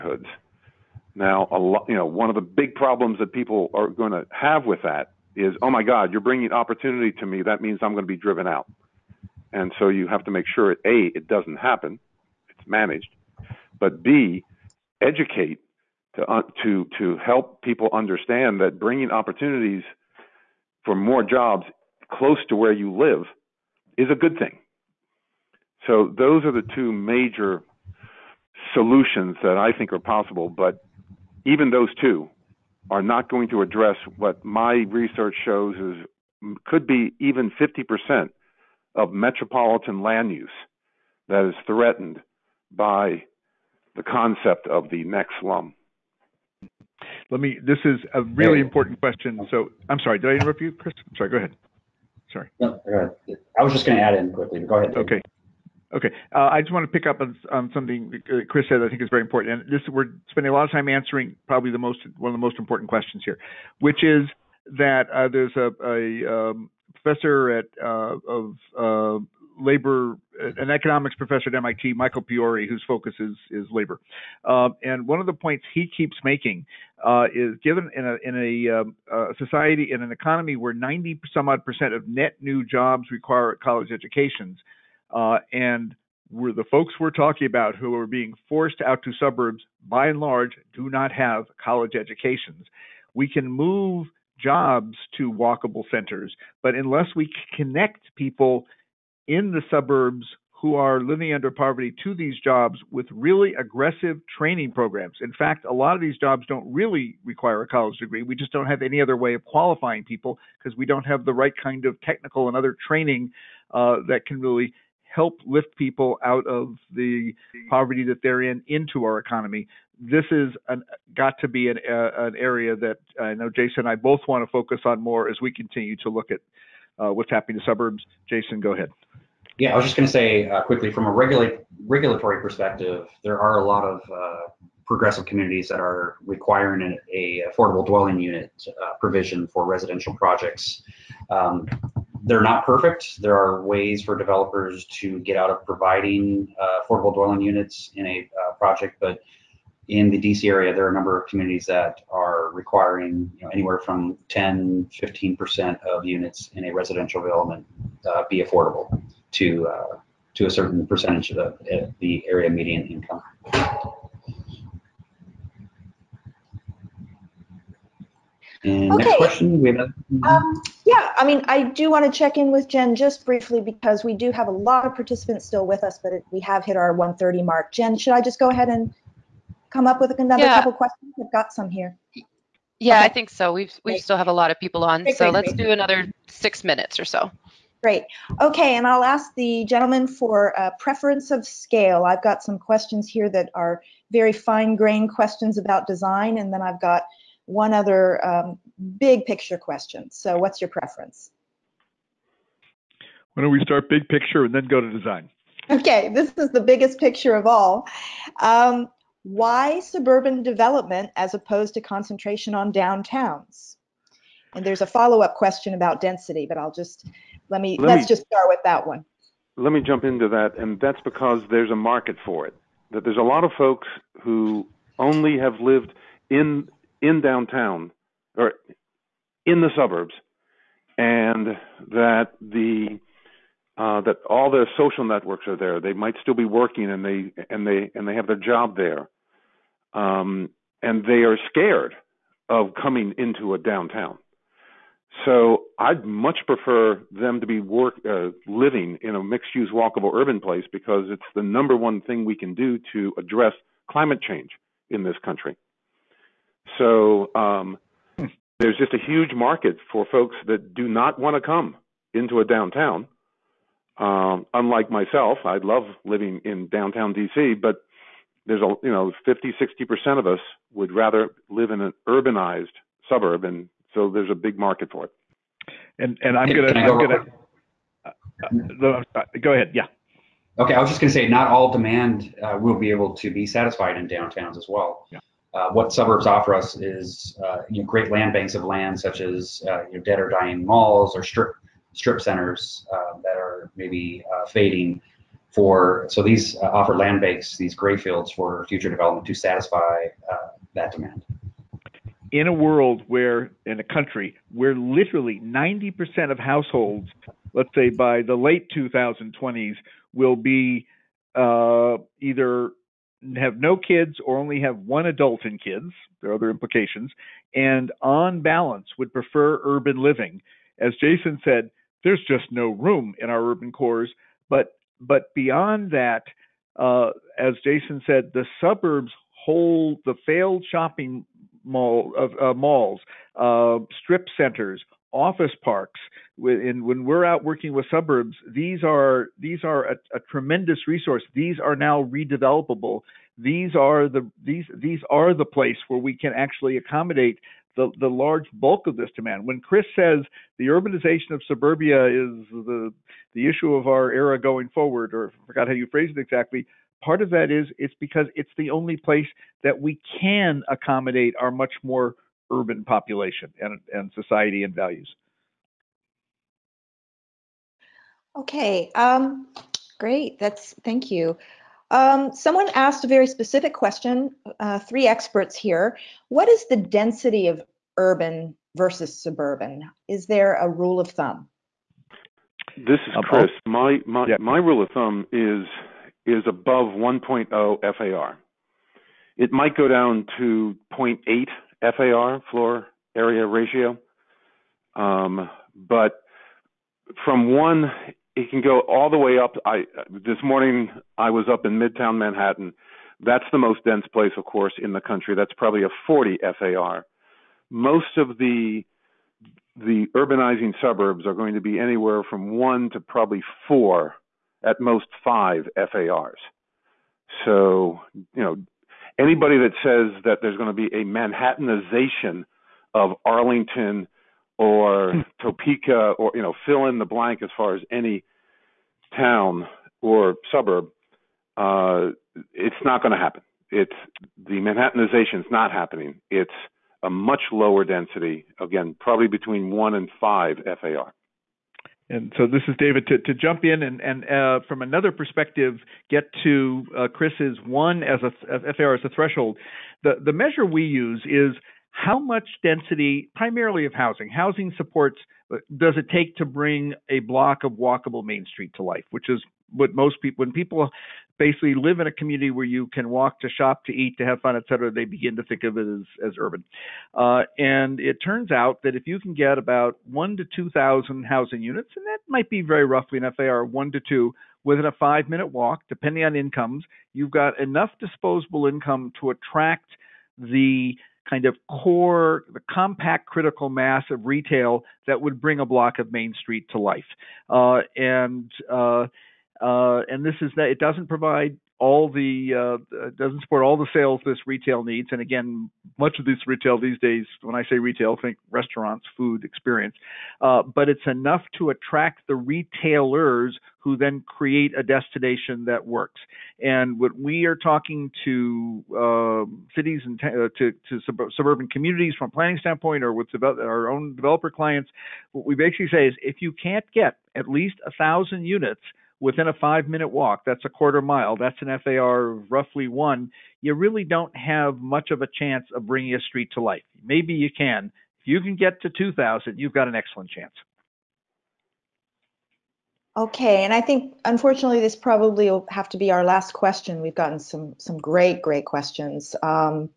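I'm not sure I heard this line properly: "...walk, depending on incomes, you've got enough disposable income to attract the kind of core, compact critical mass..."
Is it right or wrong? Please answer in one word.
right.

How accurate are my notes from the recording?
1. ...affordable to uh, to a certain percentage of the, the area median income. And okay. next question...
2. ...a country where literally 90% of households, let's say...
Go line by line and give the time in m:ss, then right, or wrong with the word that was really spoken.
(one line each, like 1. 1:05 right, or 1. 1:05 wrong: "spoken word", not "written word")
1. 2:38 right
2. 5:03 right.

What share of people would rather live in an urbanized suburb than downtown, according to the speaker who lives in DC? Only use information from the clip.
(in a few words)
50 to 60 percent.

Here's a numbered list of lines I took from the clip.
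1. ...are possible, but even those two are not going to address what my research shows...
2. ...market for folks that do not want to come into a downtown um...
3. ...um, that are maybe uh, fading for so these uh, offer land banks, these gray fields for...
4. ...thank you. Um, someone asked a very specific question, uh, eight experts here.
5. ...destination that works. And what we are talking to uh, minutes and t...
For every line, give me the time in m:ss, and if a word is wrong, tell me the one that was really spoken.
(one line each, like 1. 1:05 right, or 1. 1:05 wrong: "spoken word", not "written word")
1. 0:29 right
2. 4:19 right
3. 4:52 right
4. 6:10 wrong: "three", not "eight"
5. 8:24 wrong: "cities", not "minutes".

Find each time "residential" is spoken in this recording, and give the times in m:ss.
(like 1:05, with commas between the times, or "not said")
2:19, 2:36.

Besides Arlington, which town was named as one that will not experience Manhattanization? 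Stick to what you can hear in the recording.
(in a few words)
Topeka.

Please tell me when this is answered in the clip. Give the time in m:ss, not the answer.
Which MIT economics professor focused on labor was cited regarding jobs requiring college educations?
1:11.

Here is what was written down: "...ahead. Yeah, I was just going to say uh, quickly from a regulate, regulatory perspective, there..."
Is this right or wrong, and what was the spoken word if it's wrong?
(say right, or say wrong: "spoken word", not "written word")
right.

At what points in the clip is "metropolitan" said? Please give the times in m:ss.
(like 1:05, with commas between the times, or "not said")
0:39.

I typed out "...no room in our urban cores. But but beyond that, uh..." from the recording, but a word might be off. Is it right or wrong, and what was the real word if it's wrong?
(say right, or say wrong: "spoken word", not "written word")
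right.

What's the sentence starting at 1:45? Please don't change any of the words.
In fact, a lot of these jobs don't really require a college degree.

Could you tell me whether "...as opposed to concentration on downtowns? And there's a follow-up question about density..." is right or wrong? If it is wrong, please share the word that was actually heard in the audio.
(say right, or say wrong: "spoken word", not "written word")
right.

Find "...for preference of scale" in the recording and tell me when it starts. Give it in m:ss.
3:10.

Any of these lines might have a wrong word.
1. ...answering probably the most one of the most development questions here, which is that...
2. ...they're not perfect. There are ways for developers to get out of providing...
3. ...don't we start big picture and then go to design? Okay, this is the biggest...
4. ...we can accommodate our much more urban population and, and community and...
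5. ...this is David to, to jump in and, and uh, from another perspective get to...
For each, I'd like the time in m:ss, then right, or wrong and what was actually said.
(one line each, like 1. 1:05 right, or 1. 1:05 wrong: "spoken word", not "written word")
1. 1:00 wrong: "important", not "development"
2. 2:22 right
3. 3:23 right
4. 5:59 wrong: "society", not "community"
5. 7:22 right.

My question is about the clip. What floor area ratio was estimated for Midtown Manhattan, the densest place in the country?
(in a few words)
40 FAR.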